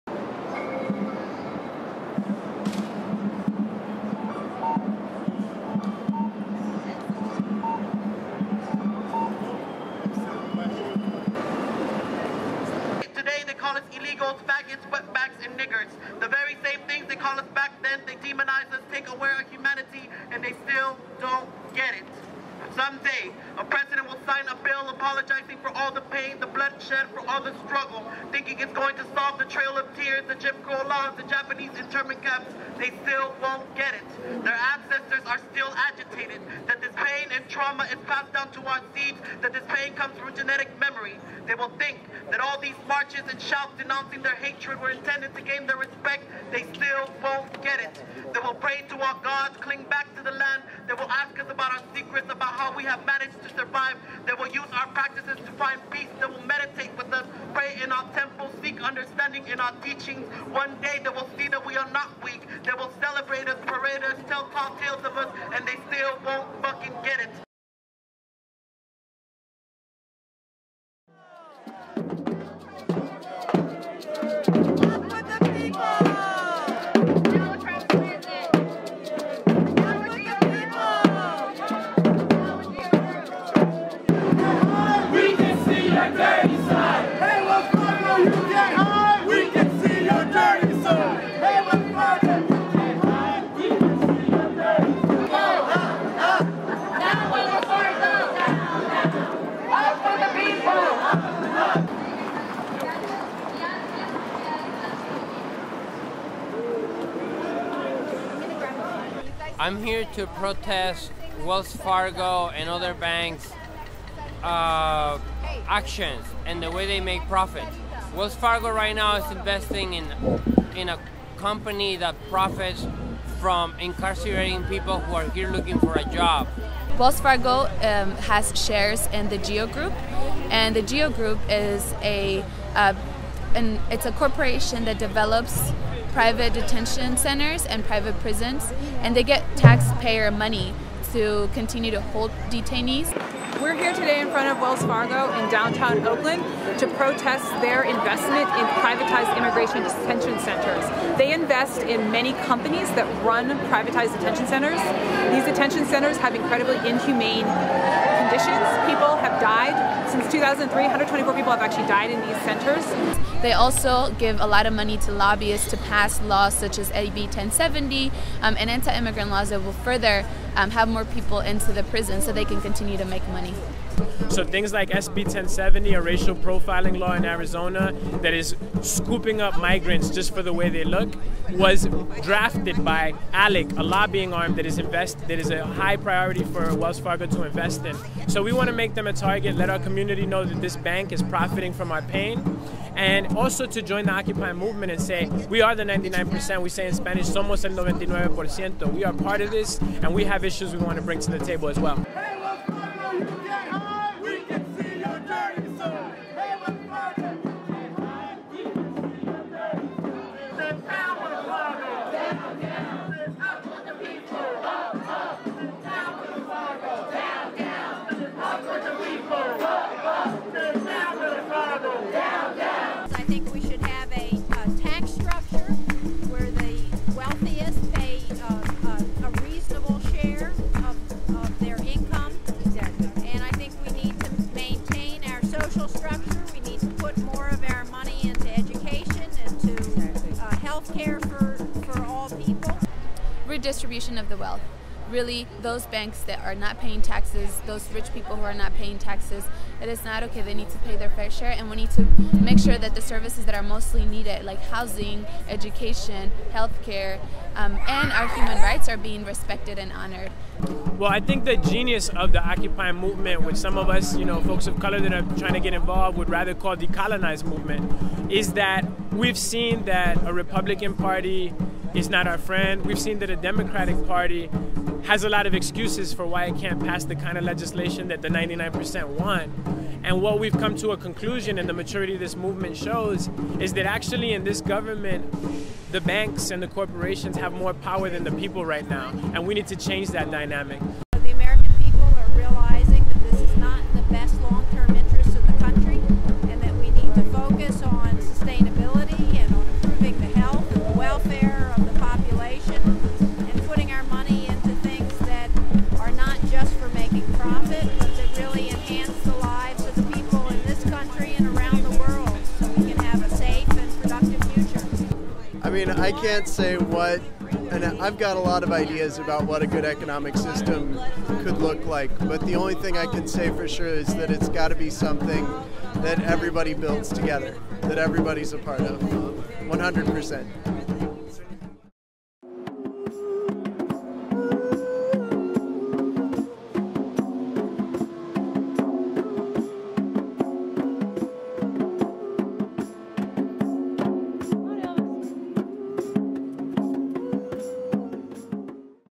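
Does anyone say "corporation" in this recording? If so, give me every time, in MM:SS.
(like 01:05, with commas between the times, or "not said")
02:14, 04:46.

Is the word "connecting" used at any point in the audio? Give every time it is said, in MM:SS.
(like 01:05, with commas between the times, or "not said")
not said.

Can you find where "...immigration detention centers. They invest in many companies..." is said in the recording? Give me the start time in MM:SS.
02:29.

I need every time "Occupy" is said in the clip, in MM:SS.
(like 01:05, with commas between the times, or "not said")
03:14, 04:22.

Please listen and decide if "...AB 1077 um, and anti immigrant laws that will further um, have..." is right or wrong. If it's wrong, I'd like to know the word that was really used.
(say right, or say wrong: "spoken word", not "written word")
wrong: "1070", not "1077".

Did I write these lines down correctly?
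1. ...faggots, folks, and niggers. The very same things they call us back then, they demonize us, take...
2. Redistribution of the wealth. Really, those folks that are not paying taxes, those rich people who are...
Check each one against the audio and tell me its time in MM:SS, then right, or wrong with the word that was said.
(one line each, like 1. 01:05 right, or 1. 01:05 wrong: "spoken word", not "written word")
1. 00:14 wrong: "wetbacks", not "folks"
2. 04:03 wrong: "banks", not "folks".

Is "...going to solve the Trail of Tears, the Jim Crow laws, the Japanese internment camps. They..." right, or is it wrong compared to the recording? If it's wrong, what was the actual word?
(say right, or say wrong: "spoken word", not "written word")
right.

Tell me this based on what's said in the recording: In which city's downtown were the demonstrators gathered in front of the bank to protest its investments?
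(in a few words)
Oakland.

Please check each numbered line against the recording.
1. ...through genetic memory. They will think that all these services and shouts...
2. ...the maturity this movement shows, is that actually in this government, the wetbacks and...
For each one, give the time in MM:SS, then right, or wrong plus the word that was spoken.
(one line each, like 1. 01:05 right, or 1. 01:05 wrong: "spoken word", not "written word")
1. 00:40 wrong: "marches", not "services"
2. 04:41 wrong: "banks", not "wetbacks".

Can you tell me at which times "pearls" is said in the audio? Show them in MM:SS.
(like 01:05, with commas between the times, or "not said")
not said.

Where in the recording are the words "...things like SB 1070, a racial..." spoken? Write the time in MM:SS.
02:54.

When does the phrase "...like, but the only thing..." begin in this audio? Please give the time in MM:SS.
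05:21.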